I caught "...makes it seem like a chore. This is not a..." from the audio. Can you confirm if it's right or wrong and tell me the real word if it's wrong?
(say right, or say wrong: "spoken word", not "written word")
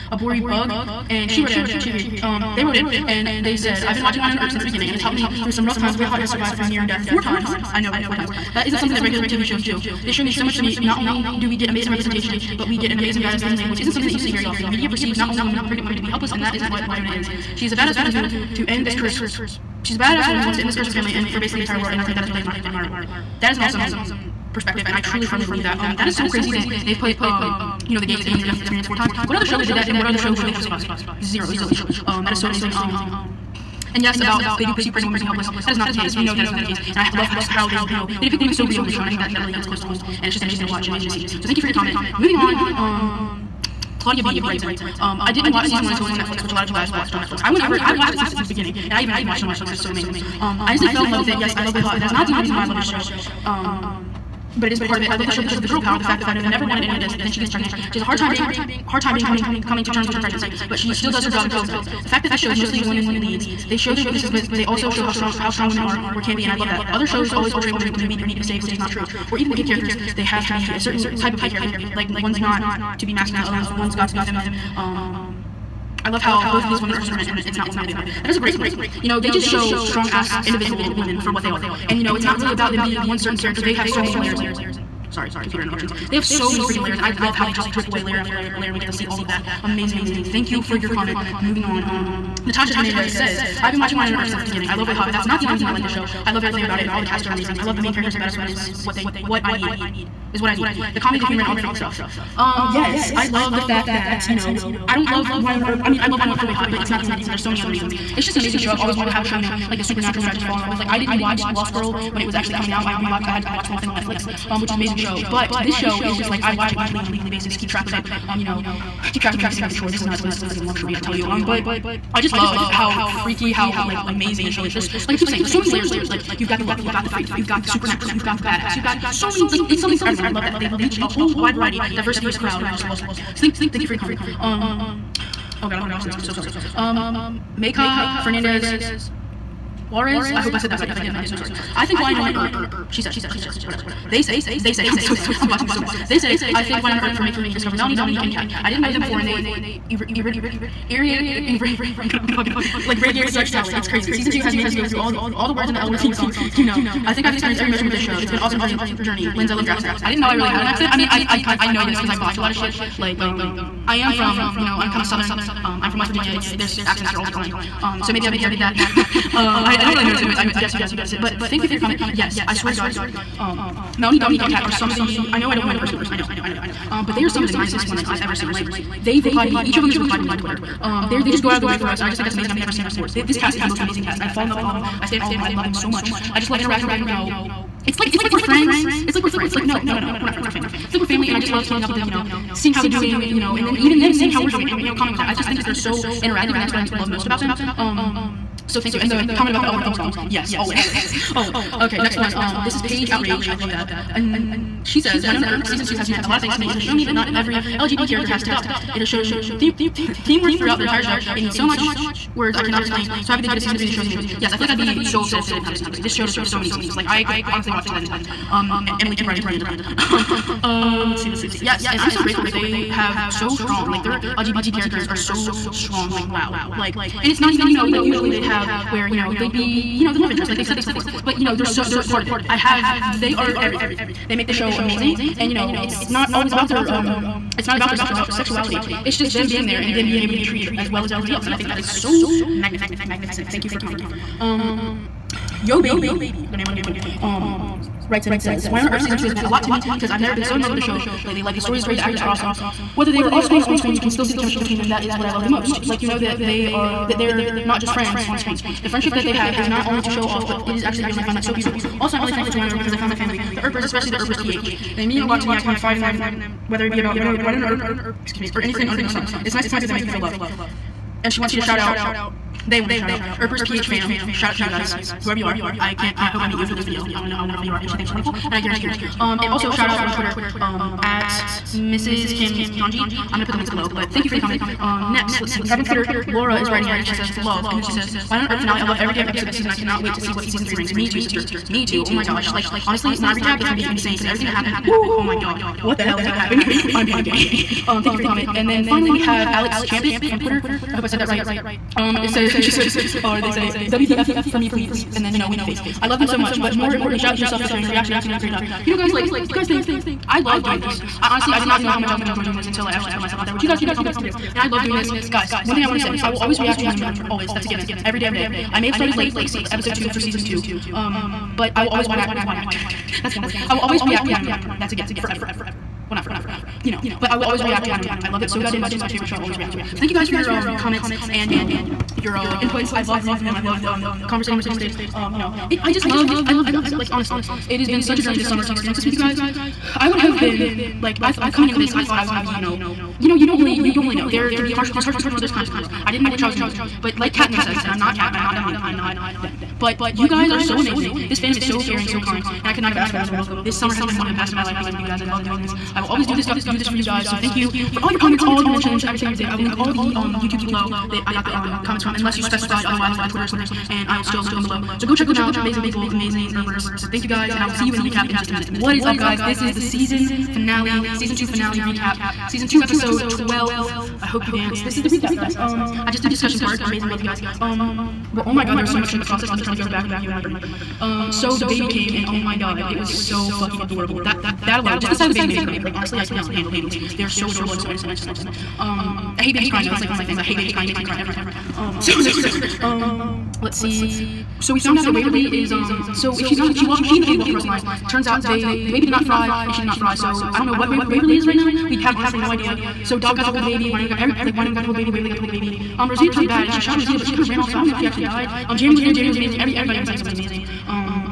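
right.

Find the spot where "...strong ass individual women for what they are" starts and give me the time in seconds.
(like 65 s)
79 s.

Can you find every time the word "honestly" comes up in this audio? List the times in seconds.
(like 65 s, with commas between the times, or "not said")
217 s, 292 s, 311 s, 337 s, 385 s, 402 s.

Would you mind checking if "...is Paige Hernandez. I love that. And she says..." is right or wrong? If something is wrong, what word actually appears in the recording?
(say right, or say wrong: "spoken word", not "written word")
wrong: "Outrage", not "Hernandez".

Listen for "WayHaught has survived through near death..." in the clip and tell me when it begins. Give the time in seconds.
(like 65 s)
5 s.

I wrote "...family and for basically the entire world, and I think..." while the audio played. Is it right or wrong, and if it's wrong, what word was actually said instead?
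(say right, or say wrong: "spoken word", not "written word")
right.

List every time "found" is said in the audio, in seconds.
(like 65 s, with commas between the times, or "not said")
262 s, 394 s.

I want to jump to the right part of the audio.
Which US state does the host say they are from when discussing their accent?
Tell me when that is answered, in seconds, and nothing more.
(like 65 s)
165 s.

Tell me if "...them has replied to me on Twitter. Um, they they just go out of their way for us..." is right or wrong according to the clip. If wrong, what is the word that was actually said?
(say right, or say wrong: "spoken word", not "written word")
right.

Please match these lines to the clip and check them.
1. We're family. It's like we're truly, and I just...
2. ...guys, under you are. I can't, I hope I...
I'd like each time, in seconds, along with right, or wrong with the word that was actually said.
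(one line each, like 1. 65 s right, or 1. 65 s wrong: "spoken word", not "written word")
1. 190 s wrong: "family", not "truly"
2. 274 s wrong: "whoever", not "under".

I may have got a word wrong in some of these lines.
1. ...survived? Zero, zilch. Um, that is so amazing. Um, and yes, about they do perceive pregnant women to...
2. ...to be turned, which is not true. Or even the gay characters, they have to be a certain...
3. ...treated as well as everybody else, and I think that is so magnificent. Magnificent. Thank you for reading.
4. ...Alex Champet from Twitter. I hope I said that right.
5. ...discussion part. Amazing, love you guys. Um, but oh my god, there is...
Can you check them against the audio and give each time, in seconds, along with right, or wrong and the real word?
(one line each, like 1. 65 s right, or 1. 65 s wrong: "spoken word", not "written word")
1. 30 s right
2. 68 s wrong: "saved", not "turned"
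3. 240 s wrong: "commenting", not "reading"
4. 299 s right
5. 376 s right.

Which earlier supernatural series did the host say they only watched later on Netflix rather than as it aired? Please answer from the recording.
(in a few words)
Lost Girl.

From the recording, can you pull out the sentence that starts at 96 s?
I love everything about it, and all the cast are amazing.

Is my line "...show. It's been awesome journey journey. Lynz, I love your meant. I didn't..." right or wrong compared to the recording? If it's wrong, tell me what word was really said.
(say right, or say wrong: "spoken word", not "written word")
wrong: "accent", not "meant".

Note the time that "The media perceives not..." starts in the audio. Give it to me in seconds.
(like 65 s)
14 s.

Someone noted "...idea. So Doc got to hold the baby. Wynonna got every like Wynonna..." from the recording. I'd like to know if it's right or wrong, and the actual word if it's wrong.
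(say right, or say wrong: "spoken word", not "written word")
right.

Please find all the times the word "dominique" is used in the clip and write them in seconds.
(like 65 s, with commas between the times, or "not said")
147 s, 174 s, 348 s.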